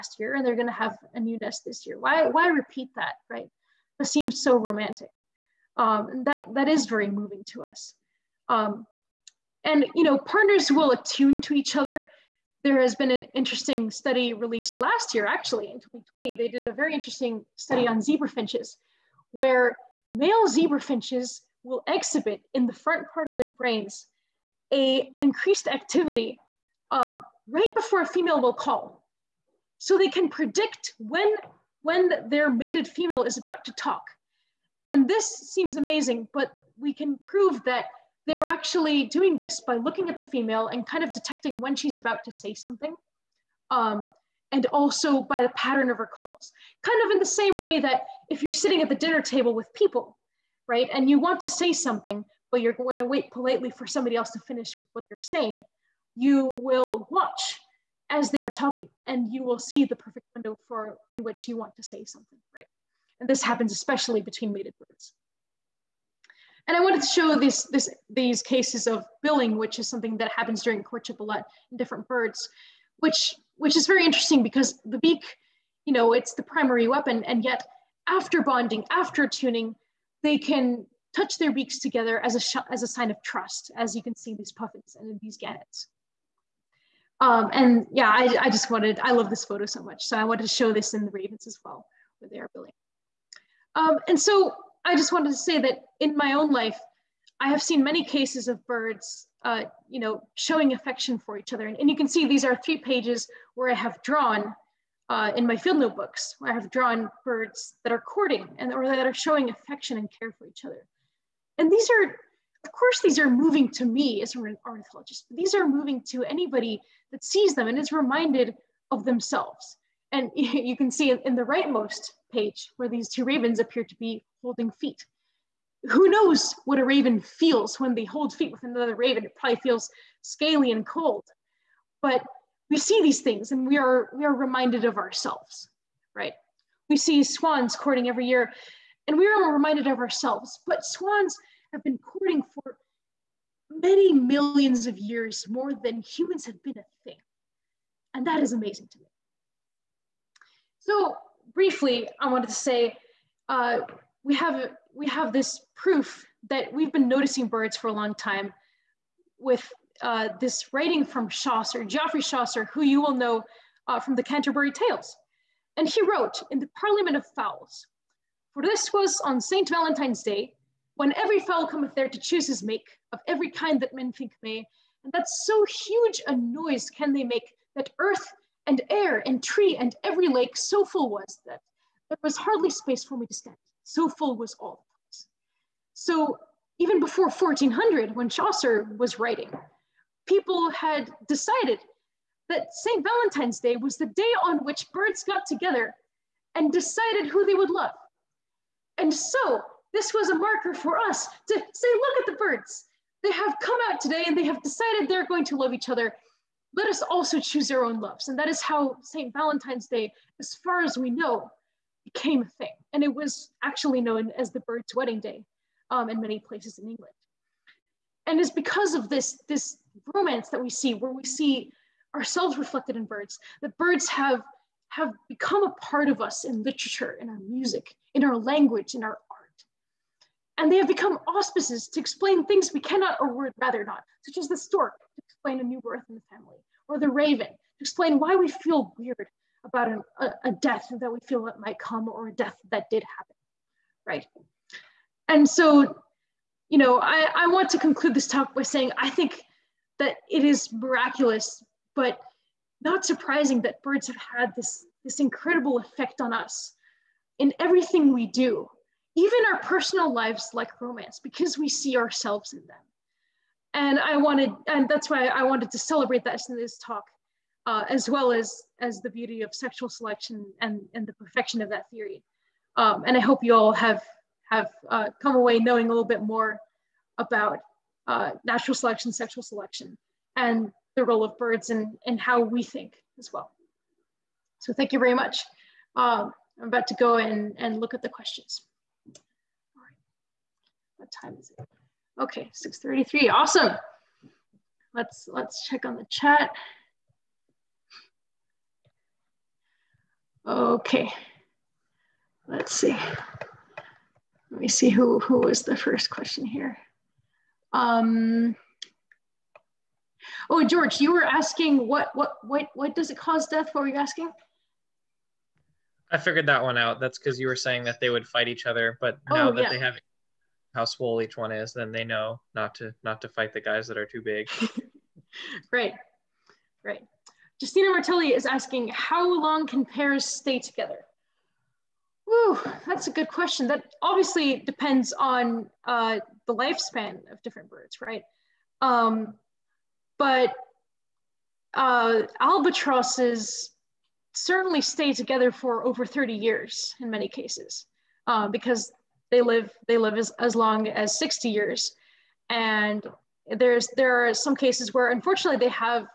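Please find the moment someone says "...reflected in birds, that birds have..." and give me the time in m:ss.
3:42.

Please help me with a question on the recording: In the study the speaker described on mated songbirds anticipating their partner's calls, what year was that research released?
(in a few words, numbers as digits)
2020.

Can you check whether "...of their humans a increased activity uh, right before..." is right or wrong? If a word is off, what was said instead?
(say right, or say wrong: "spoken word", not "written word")
wrong: "brains", not "humans".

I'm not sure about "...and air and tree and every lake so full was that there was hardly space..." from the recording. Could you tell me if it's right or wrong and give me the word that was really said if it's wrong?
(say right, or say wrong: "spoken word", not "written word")
right.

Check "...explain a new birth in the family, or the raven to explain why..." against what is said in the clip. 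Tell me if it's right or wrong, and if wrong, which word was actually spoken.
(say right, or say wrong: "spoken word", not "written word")
right.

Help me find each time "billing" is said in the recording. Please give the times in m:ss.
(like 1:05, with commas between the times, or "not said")
1:09, 1:32.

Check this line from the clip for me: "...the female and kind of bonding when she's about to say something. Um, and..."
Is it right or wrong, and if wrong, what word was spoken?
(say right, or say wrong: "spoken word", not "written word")
wrong: "detecting", not "bonding".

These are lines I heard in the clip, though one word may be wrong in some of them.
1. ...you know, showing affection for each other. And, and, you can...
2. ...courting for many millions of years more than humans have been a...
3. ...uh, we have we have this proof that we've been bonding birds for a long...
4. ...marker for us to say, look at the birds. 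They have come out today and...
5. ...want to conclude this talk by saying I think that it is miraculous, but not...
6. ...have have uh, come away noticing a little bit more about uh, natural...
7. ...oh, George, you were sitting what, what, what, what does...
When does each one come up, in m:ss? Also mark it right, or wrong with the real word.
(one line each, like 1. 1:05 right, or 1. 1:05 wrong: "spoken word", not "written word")
1. 1:39 right
2. 2:21 right
3. 2:33 wrong: "noticing", not "bonding"
4. 3:20 right
5. 4:07 right
6. 4:33 wrong: "knowing", not "noticing"
7. 5:10 wrong: "asking", not "sitting".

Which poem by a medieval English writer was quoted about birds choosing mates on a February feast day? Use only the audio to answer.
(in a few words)
The Parliament of Fowls.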